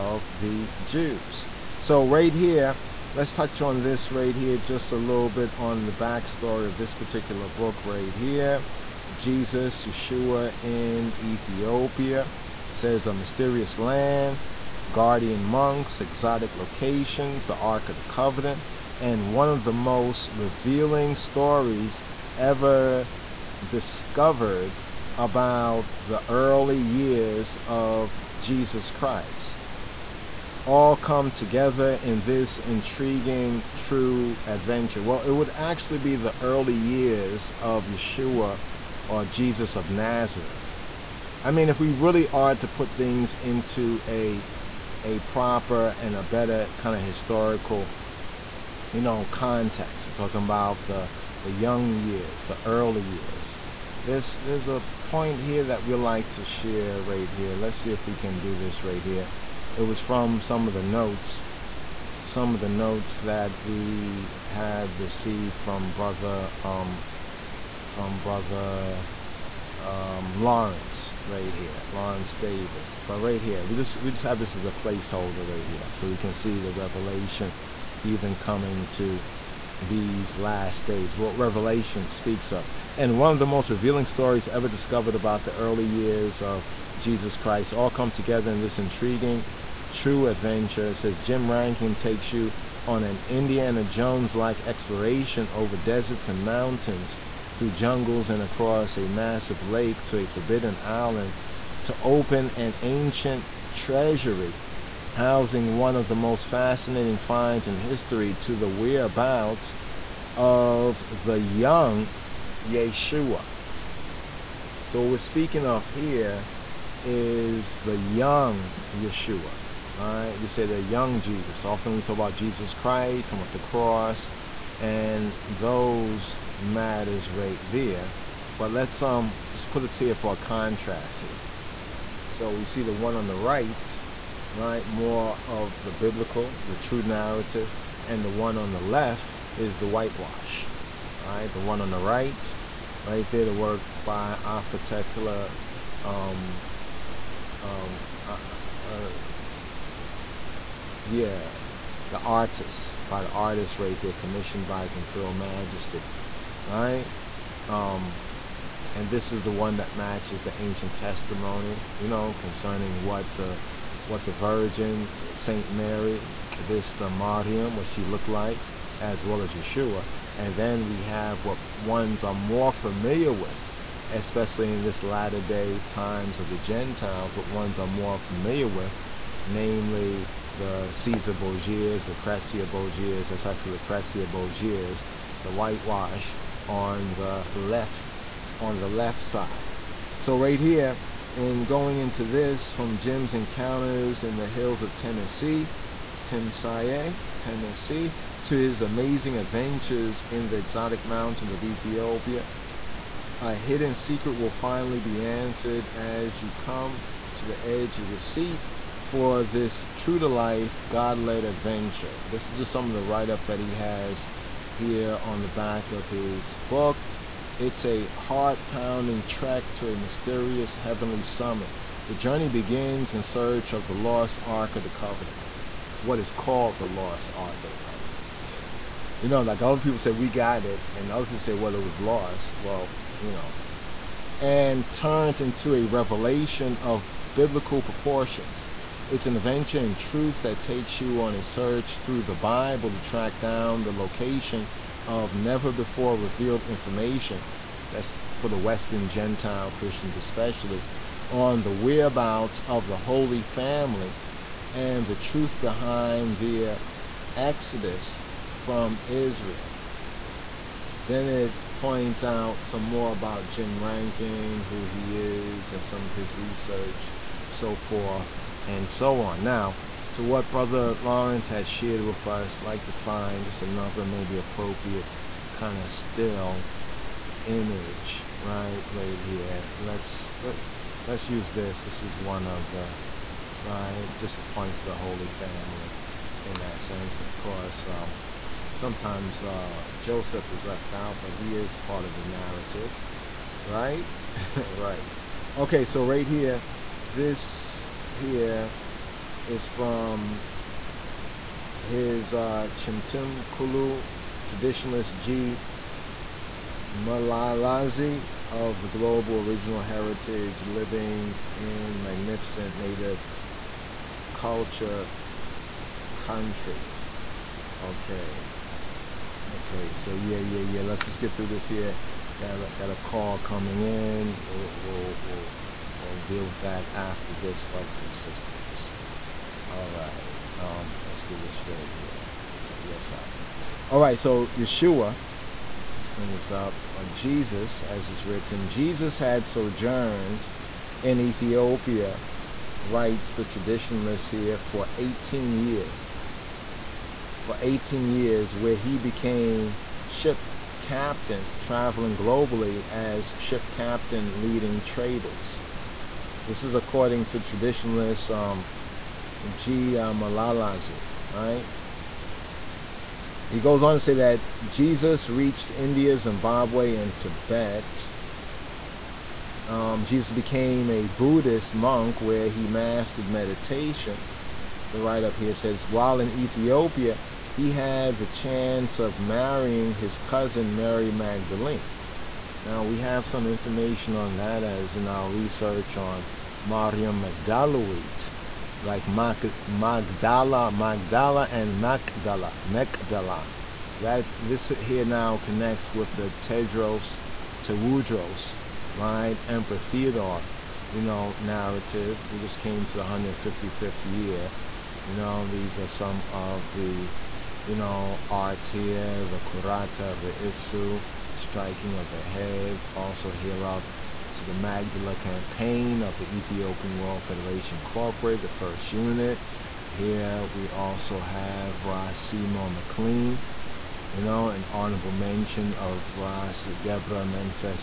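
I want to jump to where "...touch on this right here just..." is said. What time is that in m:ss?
0:03.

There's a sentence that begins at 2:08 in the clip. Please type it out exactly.
But let's um just put this here for a contrast here.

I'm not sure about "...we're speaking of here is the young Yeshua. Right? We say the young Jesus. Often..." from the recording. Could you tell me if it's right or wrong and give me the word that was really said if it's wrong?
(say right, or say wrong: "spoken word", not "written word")
right.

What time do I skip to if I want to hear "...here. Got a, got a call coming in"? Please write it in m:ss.
5:21.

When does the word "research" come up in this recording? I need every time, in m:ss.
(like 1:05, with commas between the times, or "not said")
4:26, 6:25.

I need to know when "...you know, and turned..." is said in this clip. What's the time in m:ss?
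3:53.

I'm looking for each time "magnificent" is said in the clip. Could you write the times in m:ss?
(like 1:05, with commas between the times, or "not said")
5:11.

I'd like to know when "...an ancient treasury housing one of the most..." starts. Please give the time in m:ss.
1:42.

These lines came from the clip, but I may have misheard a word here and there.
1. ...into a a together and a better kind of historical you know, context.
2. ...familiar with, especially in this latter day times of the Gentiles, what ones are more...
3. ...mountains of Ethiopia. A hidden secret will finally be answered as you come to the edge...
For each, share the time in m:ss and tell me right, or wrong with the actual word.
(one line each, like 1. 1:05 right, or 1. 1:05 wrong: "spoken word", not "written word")
1. 0:43 wrong: "proper", not "together"
2. 2:52 right
3. 3:21 right.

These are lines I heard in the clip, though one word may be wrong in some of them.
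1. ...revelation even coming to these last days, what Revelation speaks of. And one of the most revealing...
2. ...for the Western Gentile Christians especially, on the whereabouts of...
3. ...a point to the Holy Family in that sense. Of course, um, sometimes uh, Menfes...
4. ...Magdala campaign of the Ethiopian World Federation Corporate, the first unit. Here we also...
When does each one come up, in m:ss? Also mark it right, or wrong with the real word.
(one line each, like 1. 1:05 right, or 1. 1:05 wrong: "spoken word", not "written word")
1. 1:16 right
2. 4:08 right
3. 4:44 wrong: "Joseph", not "Menfes"
4. 6:54 right.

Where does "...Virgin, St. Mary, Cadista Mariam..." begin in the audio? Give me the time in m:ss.
2:44.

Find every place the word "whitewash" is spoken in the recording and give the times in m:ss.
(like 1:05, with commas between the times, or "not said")
2:19, 3:05.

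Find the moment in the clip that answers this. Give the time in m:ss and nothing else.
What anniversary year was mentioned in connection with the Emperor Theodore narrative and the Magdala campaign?
6:43.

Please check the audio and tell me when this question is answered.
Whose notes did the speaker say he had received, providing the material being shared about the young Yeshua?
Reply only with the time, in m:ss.
1:11.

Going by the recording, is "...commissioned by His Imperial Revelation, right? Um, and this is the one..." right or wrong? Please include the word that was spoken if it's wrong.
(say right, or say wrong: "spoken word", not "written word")
wrong: "Majesty", not "Revelation".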